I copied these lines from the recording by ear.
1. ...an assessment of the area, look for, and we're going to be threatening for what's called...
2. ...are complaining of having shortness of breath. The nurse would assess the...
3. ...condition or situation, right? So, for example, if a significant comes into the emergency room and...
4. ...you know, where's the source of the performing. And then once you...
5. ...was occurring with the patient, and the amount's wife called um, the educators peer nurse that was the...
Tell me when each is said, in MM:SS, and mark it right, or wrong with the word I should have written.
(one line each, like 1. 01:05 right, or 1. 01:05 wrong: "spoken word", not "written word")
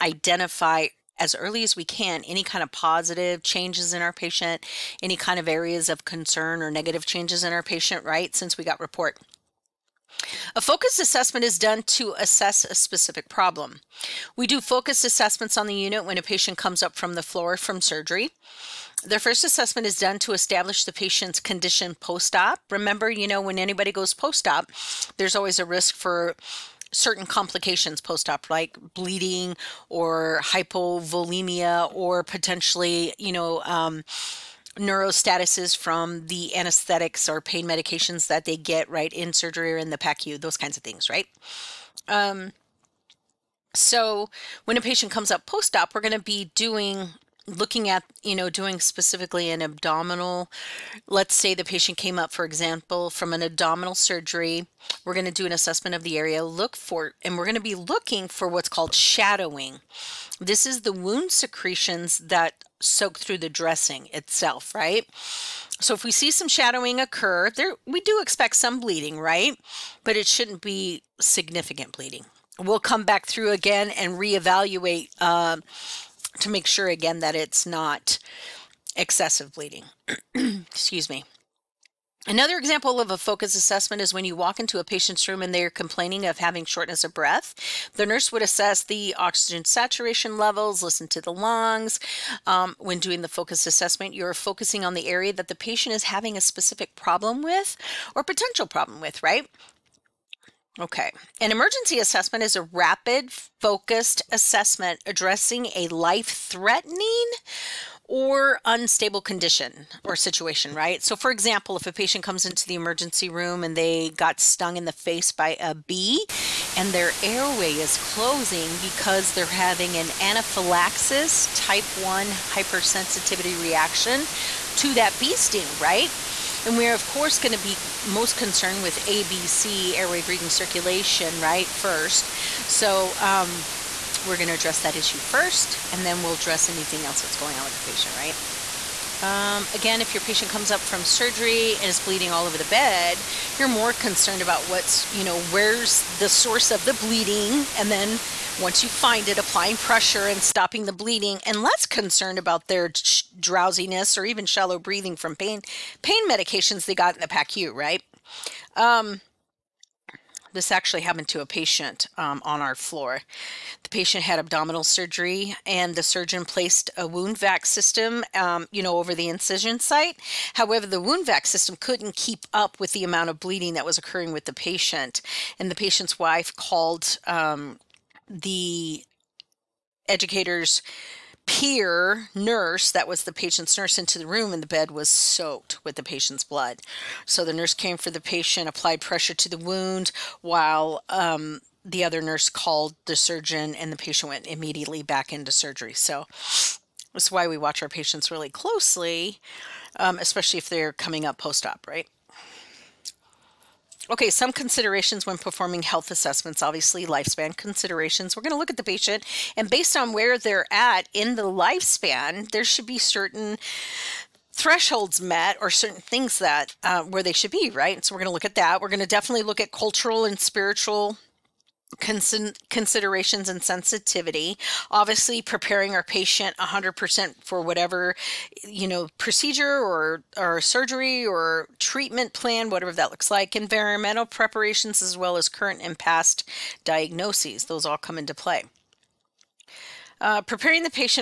1. 00:55 wrong: "looking", not "threatening"
2. 01:25 right
3. 01:49 wrong: "patient", not "significant"
4. 02:25 wrong: "bleeding", not "performing"
5. 02:53 wrong: "patient", not "amount".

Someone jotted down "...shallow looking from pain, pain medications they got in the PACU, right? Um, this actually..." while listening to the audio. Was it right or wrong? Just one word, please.
wrong.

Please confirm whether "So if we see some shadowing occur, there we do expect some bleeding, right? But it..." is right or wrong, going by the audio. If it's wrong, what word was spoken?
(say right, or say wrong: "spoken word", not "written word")
right.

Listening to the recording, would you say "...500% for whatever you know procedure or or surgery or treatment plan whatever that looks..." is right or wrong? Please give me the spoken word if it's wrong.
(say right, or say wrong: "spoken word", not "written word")
wrong: "100", not "500".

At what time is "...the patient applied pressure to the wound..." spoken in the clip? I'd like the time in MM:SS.
03:08.